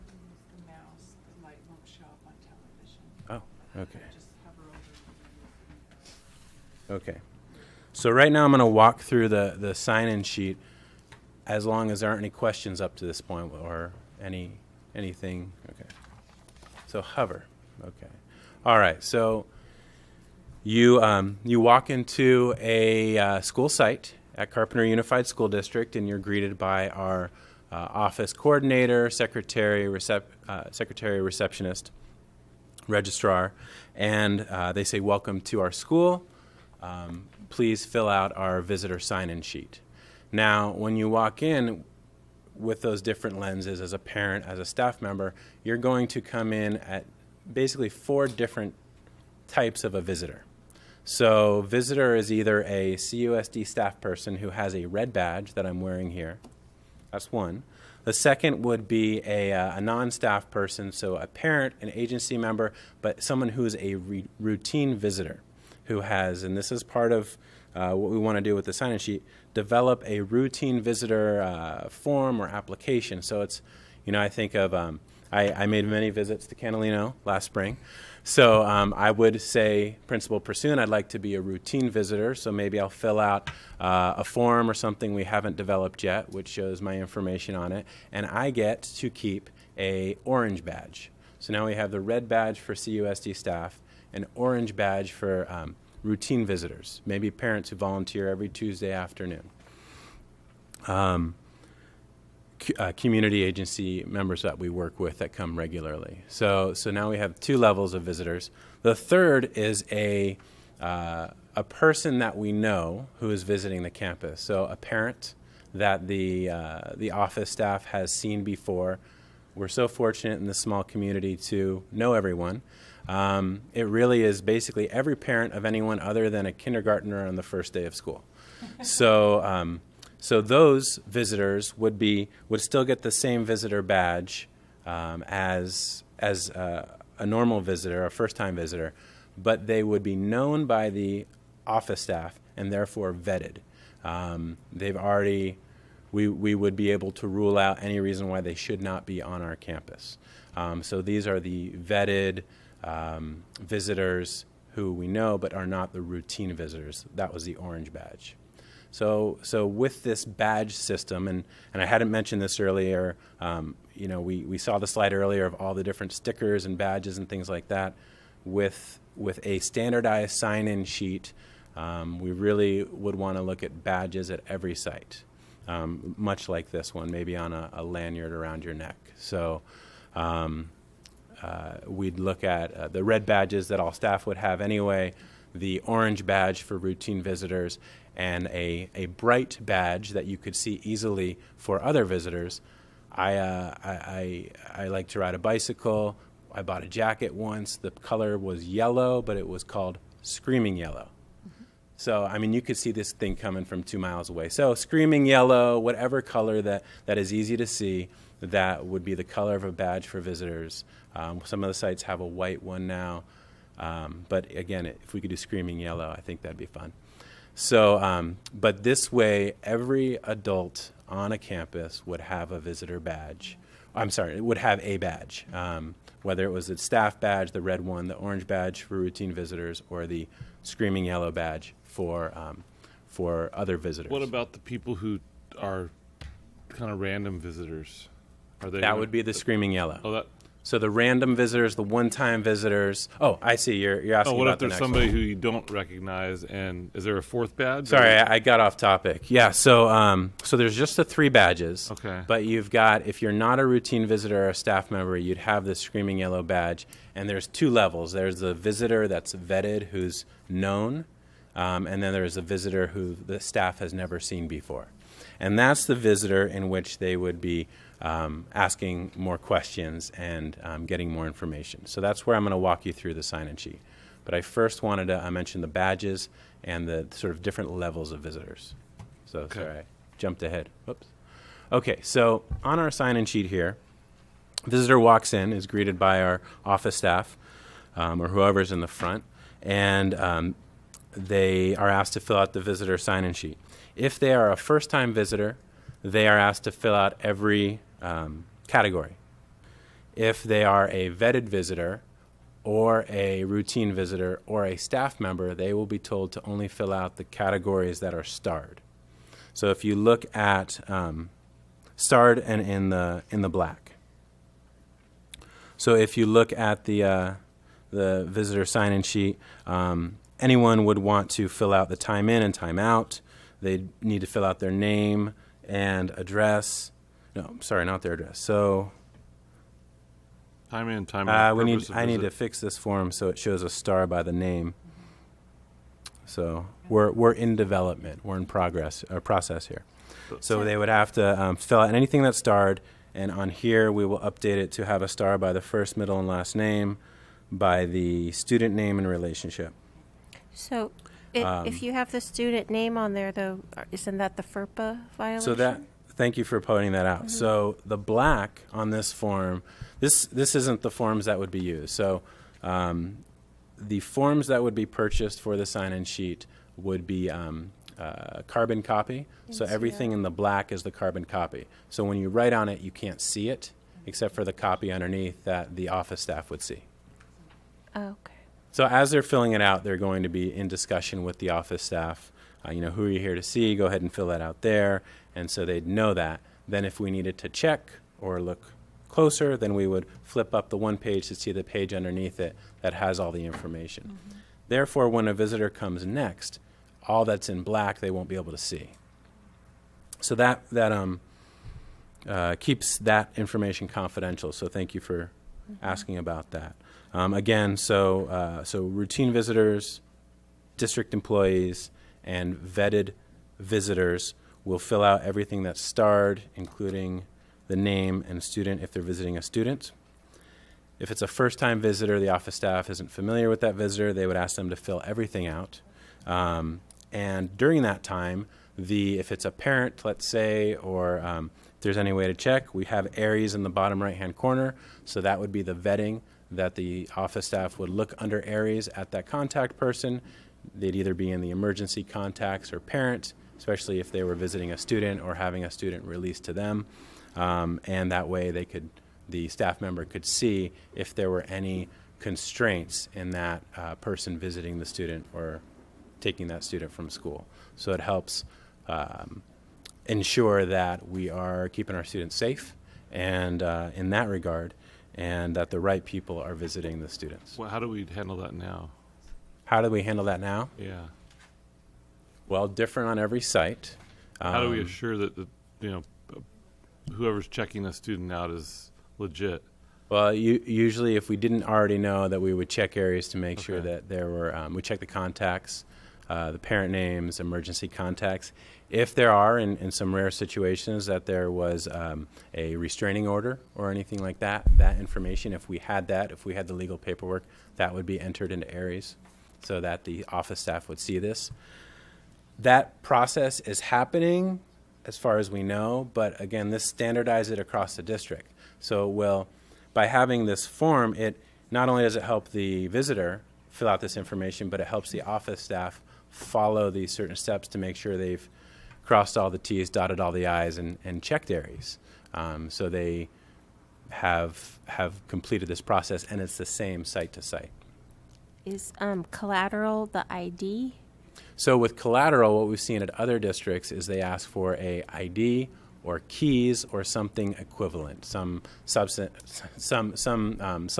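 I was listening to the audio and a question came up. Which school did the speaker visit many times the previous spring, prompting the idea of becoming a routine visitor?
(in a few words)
Canalino.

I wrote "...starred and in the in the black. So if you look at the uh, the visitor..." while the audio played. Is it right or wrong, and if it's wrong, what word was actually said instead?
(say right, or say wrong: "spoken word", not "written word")
right.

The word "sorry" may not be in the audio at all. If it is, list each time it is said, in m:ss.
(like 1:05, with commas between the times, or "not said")
3:44, 4:07, 4:39, 5:27.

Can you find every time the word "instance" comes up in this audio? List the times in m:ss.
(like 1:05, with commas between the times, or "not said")
not said.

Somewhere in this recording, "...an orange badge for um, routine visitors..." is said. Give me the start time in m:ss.
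1:34.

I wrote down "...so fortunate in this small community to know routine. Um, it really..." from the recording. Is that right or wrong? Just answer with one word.
wrong.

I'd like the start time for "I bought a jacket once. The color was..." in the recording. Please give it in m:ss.
3:16.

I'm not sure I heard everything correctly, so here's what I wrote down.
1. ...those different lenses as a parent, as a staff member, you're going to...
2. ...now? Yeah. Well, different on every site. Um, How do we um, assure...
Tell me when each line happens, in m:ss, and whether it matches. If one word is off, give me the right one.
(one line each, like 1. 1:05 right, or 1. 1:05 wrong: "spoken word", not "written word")
1. 0:42 right
2. 7:50 right.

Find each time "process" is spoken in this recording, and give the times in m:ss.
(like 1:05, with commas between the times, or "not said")
5:39, 8:23, 8:45.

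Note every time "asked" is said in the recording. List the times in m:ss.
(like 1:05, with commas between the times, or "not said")
4:51, 4:56.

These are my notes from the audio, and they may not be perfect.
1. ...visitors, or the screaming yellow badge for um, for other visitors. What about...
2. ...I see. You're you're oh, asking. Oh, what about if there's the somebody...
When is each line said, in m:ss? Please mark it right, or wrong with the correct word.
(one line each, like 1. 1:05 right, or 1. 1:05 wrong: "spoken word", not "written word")
1. 3:49 right
2. 4:03 right.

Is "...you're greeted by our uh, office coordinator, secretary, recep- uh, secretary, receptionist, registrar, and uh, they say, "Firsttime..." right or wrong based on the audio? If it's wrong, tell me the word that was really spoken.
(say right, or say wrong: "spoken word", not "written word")
wrong: "Welcome", not "Firsttime".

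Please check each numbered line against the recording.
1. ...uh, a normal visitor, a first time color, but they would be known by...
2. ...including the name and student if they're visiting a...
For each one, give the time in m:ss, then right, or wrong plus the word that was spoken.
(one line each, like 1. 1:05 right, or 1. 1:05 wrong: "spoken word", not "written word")
1. 2:16 wrong: "visitor", not "color"
2. 6:56 right.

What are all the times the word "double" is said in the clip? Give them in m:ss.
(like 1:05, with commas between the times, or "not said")
not said.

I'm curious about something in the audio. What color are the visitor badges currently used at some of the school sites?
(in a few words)
White.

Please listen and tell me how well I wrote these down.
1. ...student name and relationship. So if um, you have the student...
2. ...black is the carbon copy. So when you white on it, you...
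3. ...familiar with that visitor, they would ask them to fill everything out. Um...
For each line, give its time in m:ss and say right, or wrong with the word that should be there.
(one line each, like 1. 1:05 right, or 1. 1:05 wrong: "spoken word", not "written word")
1. 5:48 right
2. 6:10 wrong: "write", not "white"
3. 7:03 right.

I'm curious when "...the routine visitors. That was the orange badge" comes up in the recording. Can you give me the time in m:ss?
2:35.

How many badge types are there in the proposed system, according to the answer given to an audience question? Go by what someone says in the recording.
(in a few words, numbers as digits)
3.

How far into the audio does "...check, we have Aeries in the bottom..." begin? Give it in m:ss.
7:12.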